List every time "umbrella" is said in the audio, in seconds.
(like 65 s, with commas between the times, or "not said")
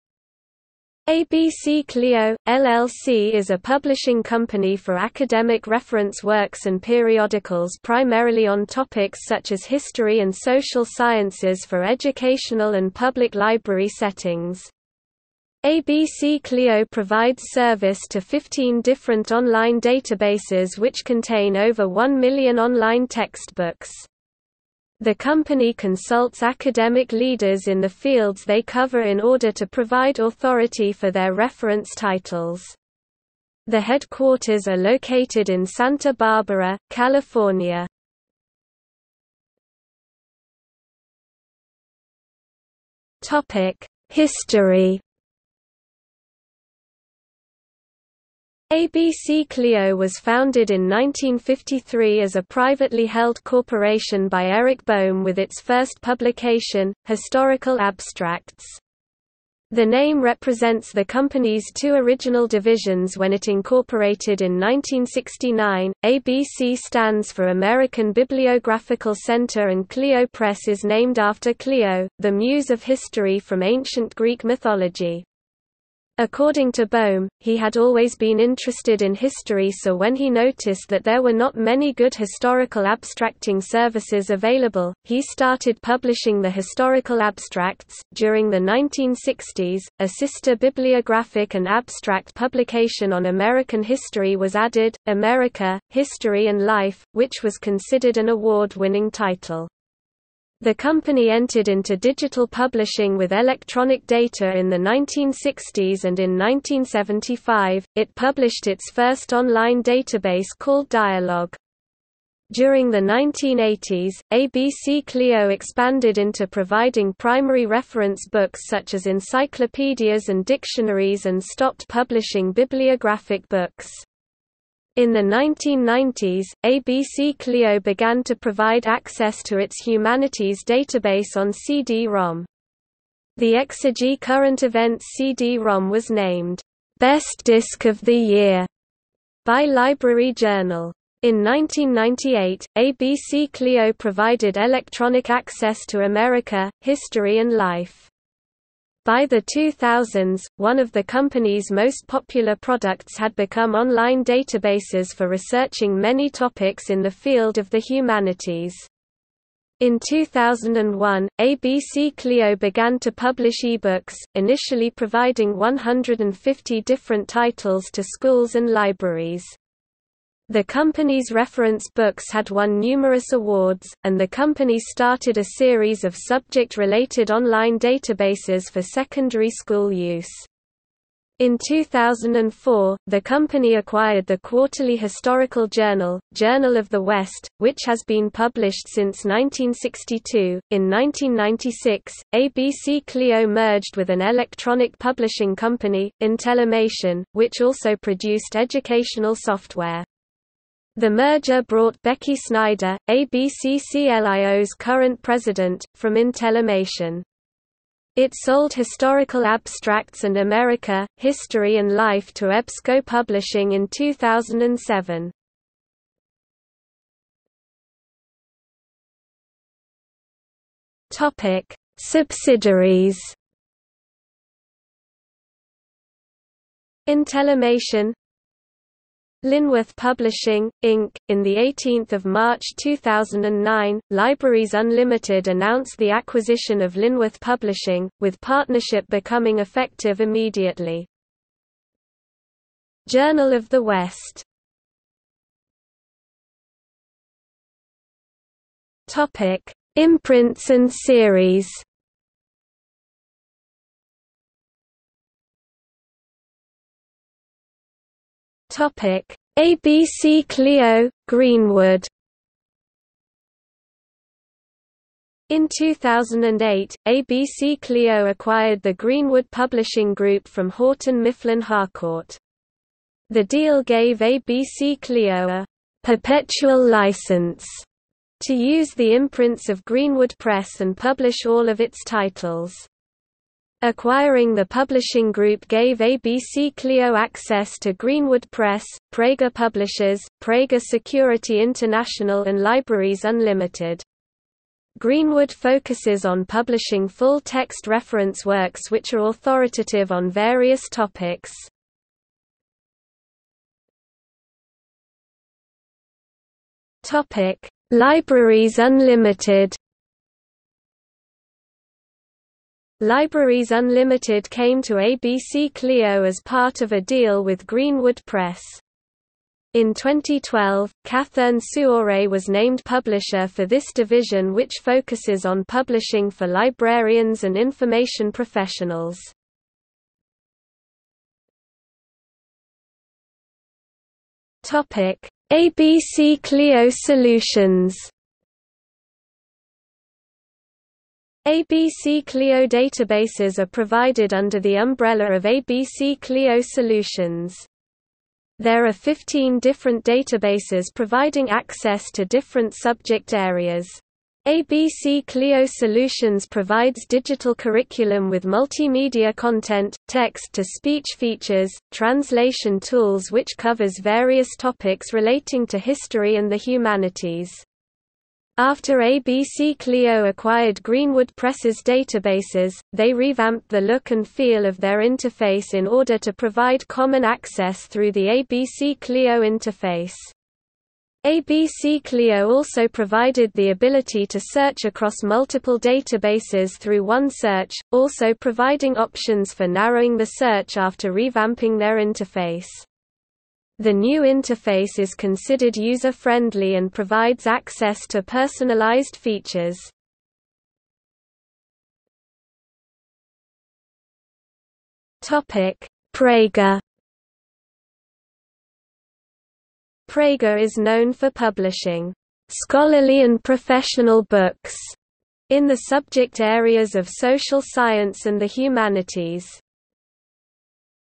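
344 s.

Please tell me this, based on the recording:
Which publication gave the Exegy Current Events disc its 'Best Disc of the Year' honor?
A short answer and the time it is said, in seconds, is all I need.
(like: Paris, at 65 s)
Library Journal, at 139 s.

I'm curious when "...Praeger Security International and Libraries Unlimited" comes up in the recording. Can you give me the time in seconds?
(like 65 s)
290 s.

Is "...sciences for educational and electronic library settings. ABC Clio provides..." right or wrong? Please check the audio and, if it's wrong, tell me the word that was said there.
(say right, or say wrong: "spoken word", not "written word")
wrong: "public", not "electronic".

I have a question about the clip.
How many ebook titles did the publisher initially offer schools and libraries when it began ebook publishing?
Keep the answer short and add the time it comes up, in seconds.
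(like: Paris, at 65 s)
150, at 165 s.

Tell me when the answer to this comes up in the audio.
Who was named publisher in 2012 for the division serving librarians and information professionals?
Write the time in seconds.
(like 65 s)
321 s.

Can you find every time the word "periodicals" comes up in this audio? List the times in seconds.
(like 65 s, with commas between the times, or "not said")
6 s.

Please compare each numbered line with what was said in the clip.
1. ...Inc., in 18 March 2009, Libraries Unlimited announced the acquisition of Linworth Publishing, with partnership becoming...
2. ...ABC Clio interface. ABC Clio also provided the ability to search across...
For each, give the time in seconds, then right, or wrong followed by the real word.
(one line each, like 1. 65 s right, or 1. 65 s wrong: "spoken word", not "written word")
1. 230 s right
2. 378 s right.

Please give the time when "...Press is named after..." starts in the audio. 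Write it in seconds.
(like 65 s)
70 s.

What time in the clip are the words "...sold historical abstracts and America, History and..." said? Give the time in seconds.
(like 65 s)
208 s.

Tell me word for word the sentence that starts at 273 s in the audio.
The deal gave ABC Clio a perpetual license to use the imprints of Greenwood Press and publish all of its titles.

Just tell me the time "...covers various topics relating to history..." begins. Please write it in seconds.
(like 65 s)
363 s.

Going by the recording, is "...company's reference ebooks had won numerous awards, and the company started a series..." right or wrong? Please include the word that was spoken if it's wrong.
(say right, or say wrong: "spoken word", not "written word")
wrong: "books", not "ebooks".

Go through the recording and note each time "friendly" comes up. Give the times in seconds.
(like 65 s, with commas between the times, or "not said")
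395 s.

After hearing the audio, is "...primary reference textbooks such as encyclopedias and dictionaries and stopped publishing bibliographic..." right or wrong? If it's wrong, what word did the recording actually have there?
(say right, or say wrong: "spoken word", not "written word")
wrong: "books", not "textbooks".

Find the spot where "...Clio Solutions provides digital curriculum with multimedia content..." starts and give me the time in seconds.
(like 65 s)
355 s.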